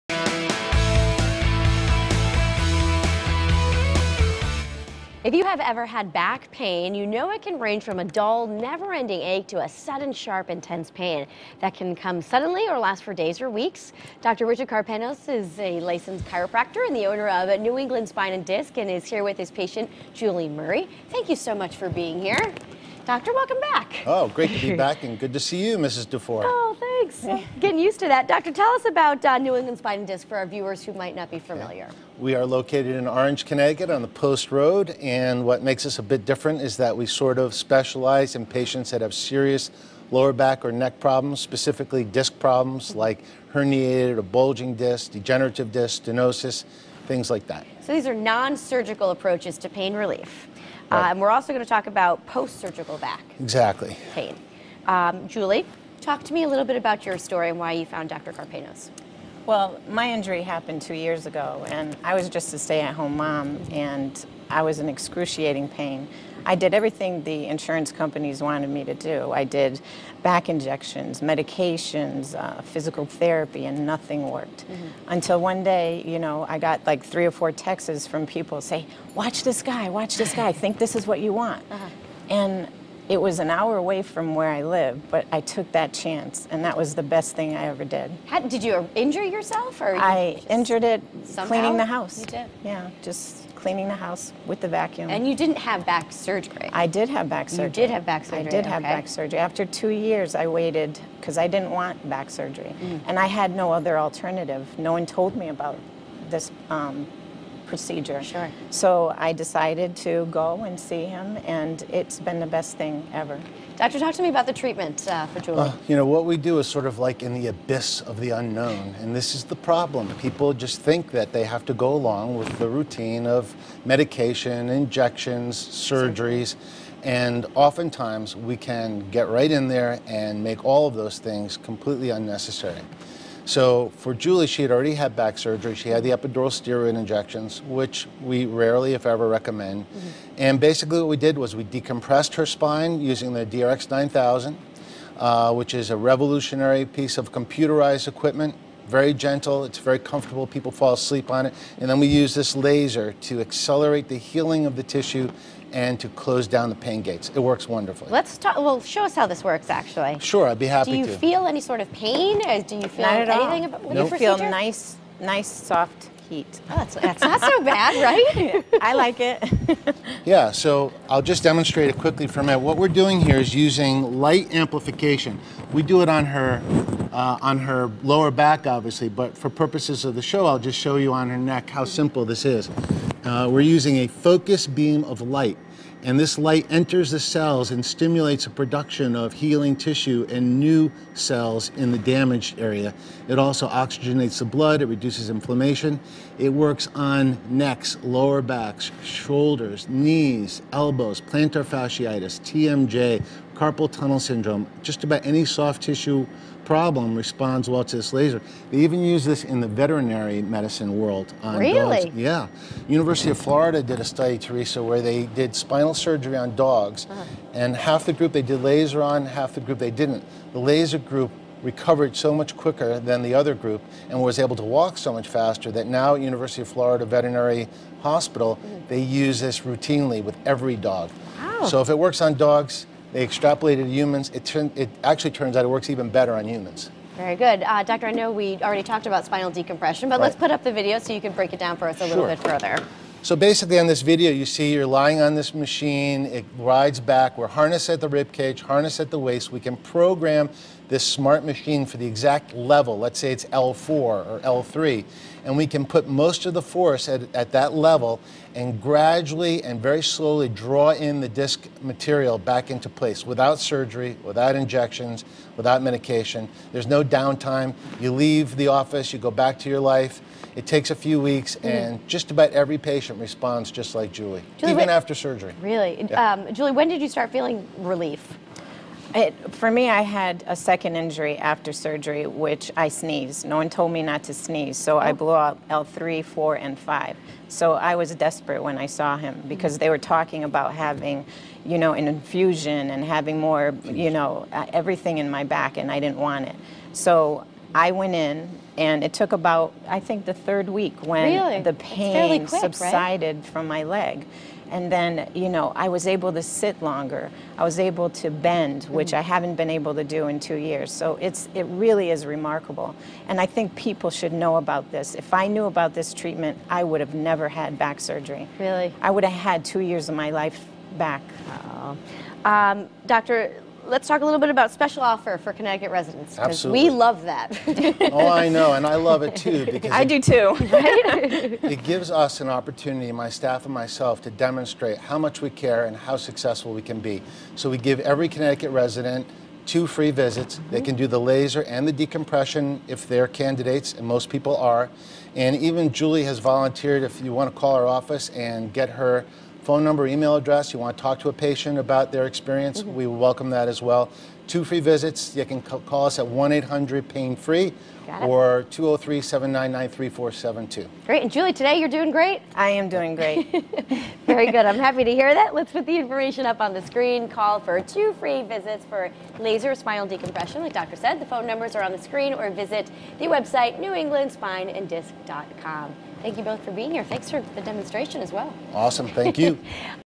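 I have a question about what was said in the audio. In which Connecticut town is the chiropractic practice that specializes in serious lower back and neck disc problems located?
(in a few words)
Orange.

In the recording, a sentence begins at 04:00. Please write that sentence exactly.
let's put up the video so you can break it down for us a sure.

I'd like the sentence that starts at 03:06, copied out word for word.
And this light enters the cells and stimulates the production of healing tissue and new cells in the damaged area.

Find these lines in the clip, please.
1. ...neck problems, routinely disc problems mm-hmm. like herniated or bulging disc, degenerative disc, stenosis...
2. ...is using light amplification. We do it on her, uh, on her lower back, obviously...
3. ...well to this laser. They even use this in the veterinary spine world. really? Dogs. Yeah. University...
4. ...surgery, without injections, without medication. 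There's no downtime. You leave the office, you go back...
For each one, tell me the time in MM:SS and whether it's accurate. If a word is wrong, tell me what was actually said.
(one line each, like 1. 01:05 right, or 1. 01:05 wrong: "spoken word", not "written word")
1. 00:40 wrong: "specifically", not "routinely"
2. 02:53 right
3. 03:27 wrong: "medicine", not "spine"
4. 04:23 right.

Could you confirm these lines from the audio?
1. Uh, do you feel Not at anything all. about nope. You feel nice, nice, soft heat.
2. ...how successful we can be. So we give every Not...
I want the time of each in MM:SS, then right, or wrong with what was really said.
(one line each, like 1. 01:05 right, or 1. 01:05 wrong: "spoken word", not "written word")
1. 02:42 right
2. 05:35 wrong: "Connecticut", not "Not".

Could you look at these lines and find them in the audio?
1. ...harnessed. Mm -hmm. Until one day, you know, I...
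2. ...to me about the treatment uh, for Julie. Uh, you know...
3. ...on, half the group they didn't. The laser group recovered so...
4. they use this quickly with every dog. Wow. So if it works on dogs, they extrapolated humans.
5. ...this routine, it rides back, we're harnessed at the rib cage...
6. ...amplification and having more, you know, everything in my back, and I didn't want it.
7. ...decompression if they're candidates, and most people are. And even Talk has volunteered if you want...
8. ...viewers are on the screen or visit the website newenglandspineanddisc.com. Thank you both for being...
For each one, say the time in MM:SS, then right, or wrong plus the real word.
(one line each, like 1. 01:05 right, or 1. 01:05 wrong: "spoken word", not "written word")
1. 01:14 wrong: "worked", not "harnessed"
2. 01:54 right
3. 03:39 right
4. 03:48 wrong: "routinely", not "quickly"
5. 04:05 wrong: "machine", not "routine"
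6. 04:52 wrong: "infusion", not "amplification"
7. 05:41 wrong: "Julie", not "Talk"
8. 06:11 wrong: "numbers", not "viewers".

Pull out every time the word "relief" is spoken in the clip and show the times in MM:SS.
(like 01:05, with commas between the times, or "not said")
00:49, 04:37.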